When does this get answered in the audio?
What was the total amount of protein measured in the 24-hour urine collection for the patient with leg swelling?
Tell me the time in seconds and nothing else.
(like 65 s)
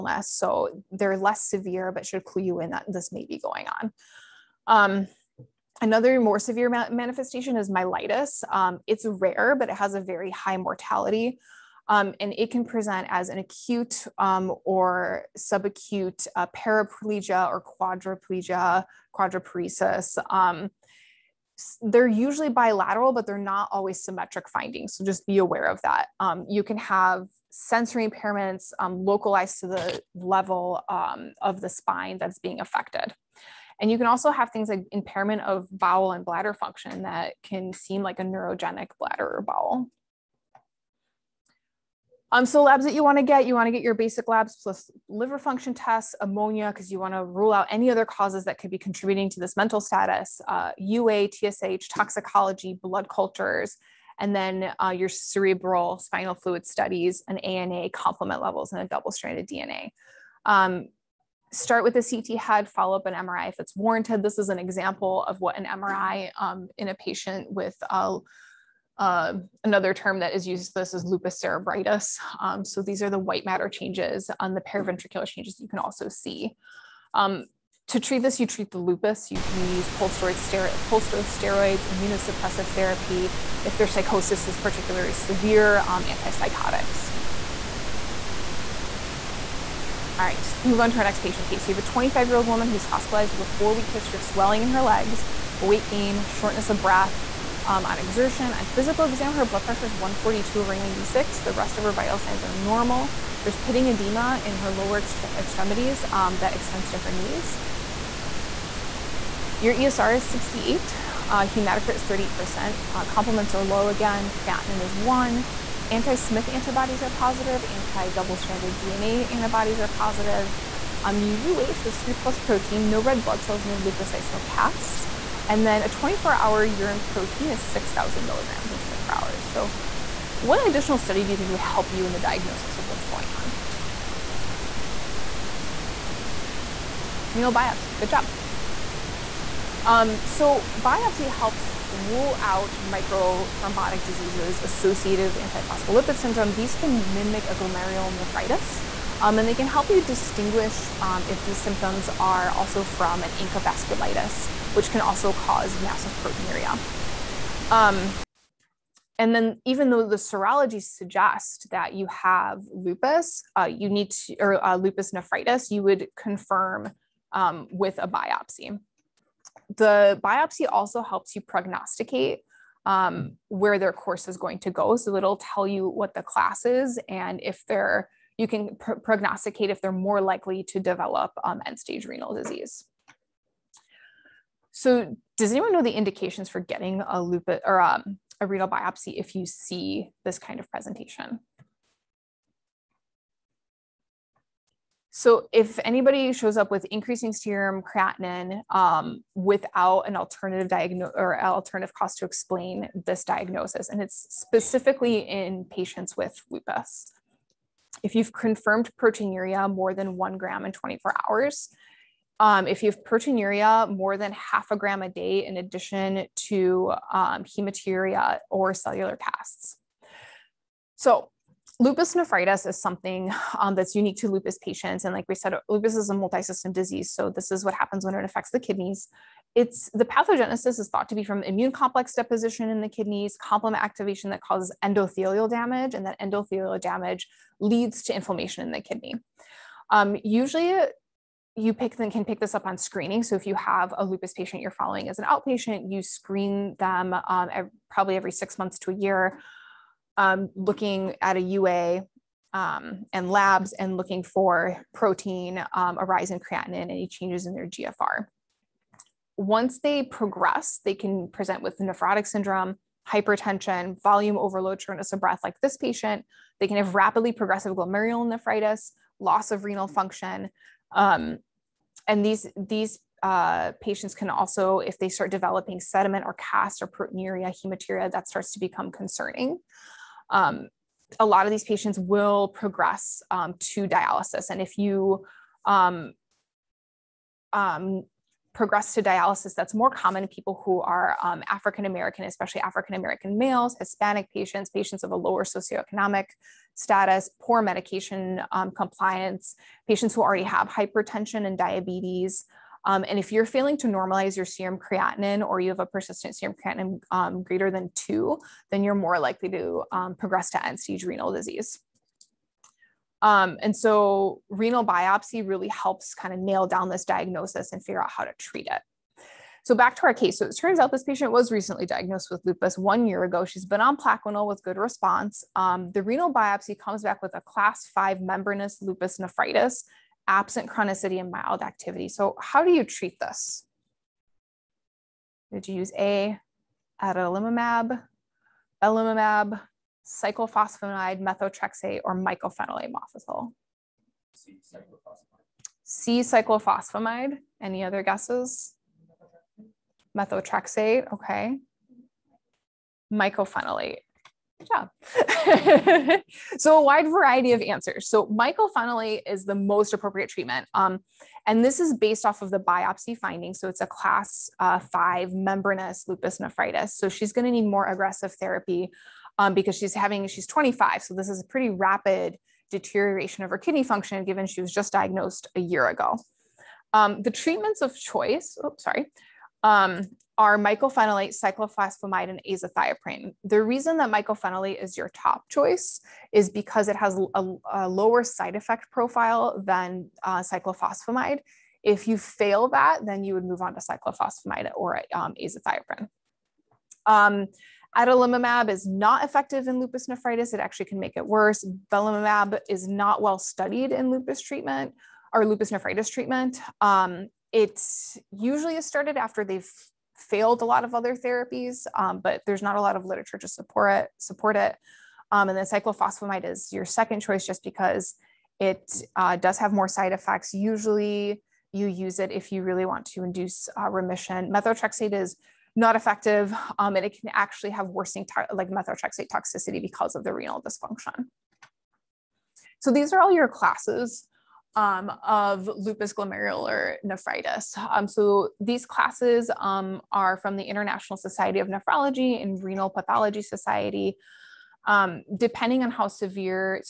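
127 s.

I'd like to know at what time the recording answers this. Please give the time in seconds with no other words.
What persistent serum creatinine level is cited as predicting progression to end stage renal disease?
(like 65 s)
307 s.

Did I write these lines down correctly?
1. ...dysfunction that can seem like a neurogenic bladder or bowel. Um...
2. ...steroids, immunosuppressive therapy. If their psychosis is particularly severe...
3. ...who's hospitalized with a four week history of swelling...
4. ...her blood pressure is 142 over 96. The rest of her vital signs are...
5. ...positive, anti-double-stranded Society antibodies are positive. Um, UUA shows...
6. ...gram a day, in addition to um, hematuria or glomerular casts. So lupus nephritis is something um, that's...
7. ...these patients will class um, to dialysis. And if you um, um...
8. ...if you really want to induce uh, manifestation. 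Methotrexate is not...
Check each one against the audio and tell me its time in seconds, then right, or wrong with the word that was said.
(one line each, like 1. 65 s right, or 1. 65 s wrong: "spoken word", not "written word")
1. 36 s wrong: "function", not "dysfunction"
2. 80 s right
3. 92 s right
4. 99 s right
5. 117 s wrong: "DNA", not "Society"
6. 214 s wrong: "cellular", not "glomerular"
7. 281 s wrong: "progress", not "class"
8. 422 s wrong: "remission", not "manifestation".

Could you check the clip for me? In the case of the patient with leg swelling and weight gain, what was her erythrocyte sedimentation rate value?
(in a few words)
68.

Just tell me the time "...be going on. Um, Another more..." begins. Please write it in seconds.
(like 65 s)
3 s.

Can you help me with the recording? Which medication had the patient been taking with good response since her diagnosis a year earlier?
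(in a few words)
Plaquenil.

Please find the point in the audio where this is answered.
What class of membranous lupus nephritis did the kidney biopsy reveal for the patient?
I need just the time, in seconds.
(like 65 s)
327 s.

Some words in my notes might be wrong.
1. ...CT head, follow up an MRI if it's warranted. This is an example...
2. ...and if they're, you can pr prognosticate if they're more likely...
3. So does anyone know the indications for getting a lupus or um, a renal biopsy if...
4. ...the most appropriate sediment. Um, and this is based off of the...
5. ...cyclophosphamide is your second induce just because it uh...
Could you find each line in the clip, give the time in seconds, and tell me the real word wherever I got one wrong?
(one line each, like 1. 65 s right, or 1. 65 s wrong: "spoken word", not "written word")
1. 62 s right
2. 177 s right
3. 184 s right
4. 359 s wrong: "treatment", not "sediment"
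5. 415 s wrong: "choice", not "induce".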